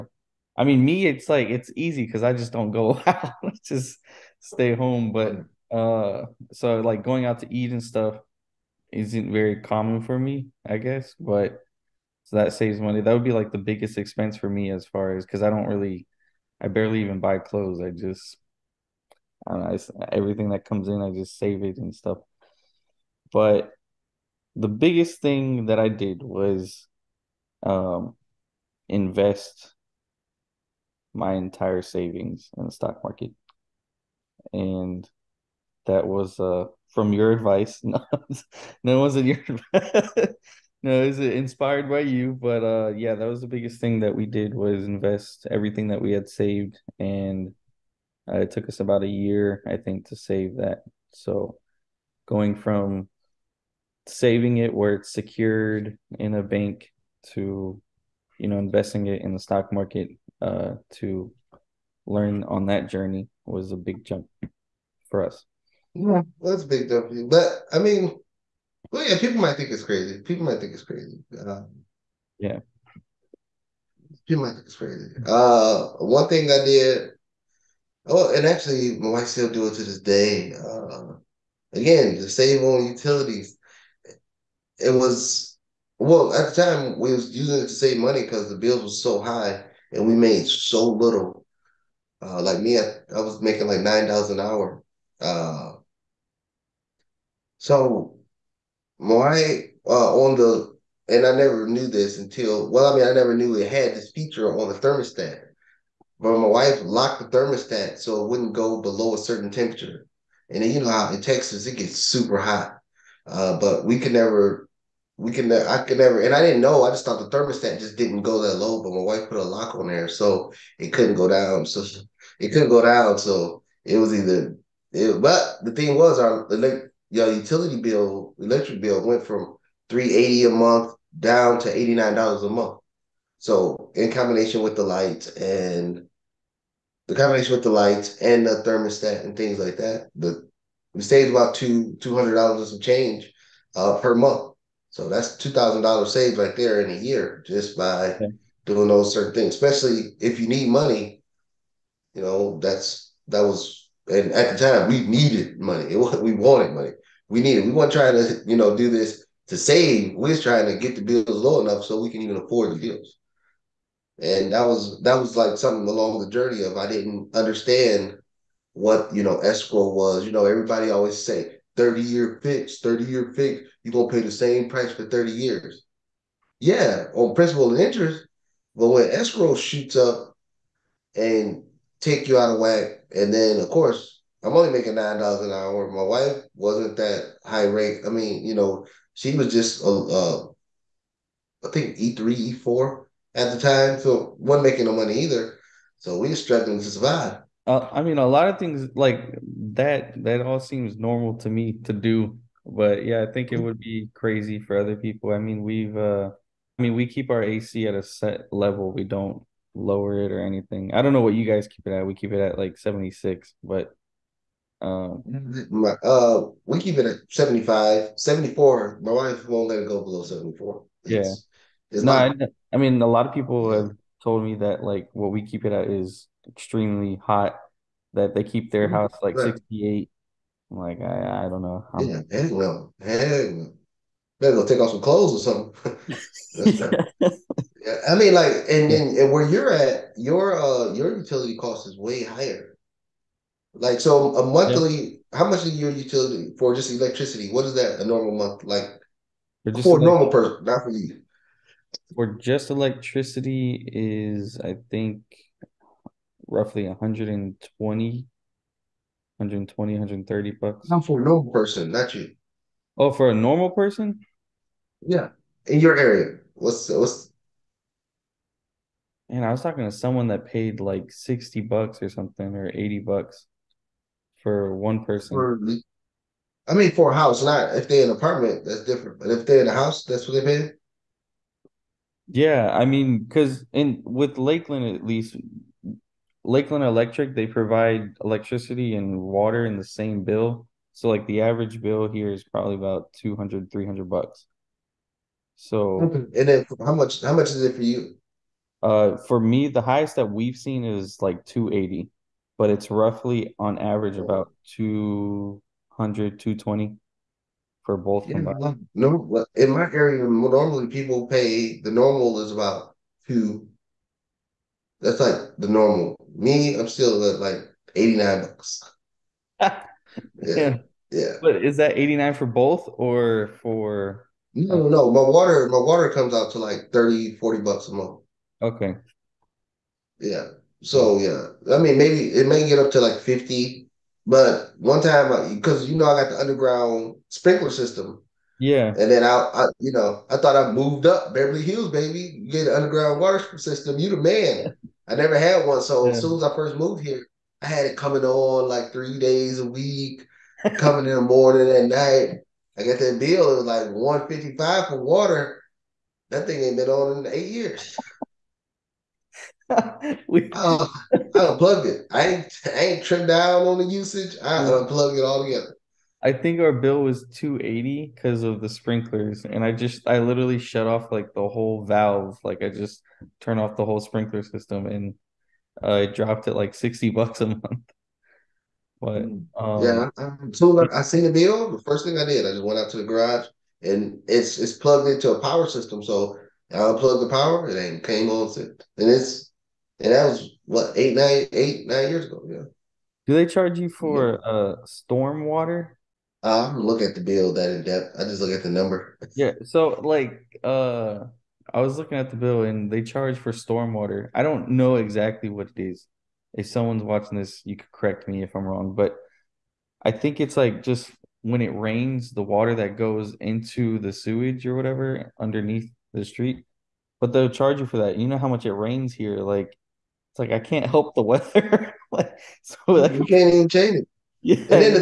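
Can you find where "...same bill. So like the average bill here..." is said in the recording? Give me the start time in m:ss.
4:49.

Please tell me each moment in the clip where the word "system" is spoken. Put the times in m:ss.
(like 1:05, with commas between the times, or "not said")
5:37, 5:43, 6:14, 6:25.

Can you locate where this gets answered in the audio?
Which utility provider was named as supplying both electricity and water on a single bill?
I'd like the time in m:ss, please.
4:46.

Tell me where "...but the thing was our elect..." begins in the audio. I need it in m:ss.
2:05.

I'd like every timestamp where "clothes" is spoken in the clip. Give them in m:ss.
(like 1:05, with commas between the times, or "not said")
0:17, 3:54.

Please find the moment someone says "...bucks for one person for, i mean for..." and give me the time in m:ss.
4:32.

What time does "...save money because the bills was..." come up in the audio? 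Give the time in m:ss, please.
1:27.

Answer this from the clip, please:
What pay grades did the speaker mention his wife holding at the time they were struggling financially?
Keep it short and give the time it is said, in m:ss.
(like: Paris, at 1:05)
E3, E4, at 3:11.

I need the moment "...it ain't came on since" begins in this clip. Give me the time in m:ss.
6:27.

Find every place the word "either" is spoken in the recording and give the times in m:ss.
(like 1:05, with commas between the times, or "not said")
2:04, 3:15.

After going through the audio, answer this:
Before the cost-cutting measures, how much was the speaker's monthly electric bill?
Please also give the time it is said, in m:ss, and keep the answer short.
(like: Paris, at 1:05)
$380, at 2:09.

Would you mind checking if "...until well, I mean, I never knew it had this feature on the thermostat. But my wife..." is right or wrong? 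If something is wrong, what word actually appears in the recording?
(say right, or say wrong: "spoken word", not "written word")
right.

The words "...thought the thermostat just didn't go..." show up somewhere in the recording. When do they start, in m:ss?
1:57.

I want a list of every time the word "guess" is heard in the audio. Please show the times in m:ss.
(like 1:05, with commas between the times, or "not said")
0:10.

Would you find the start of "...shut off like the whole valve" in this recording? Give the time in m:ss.
6:10.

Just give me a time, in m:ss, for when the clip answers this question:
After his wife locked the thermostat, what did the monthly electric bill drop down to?
2:11.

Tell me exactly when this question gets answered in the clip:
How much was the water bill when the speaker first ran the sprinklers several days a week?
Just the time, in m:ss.
5:53.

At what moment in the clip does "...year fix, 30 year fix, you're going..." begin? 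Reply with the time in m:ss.
2:52.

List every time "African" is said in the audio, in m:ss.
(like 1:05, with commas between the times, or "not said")
not said.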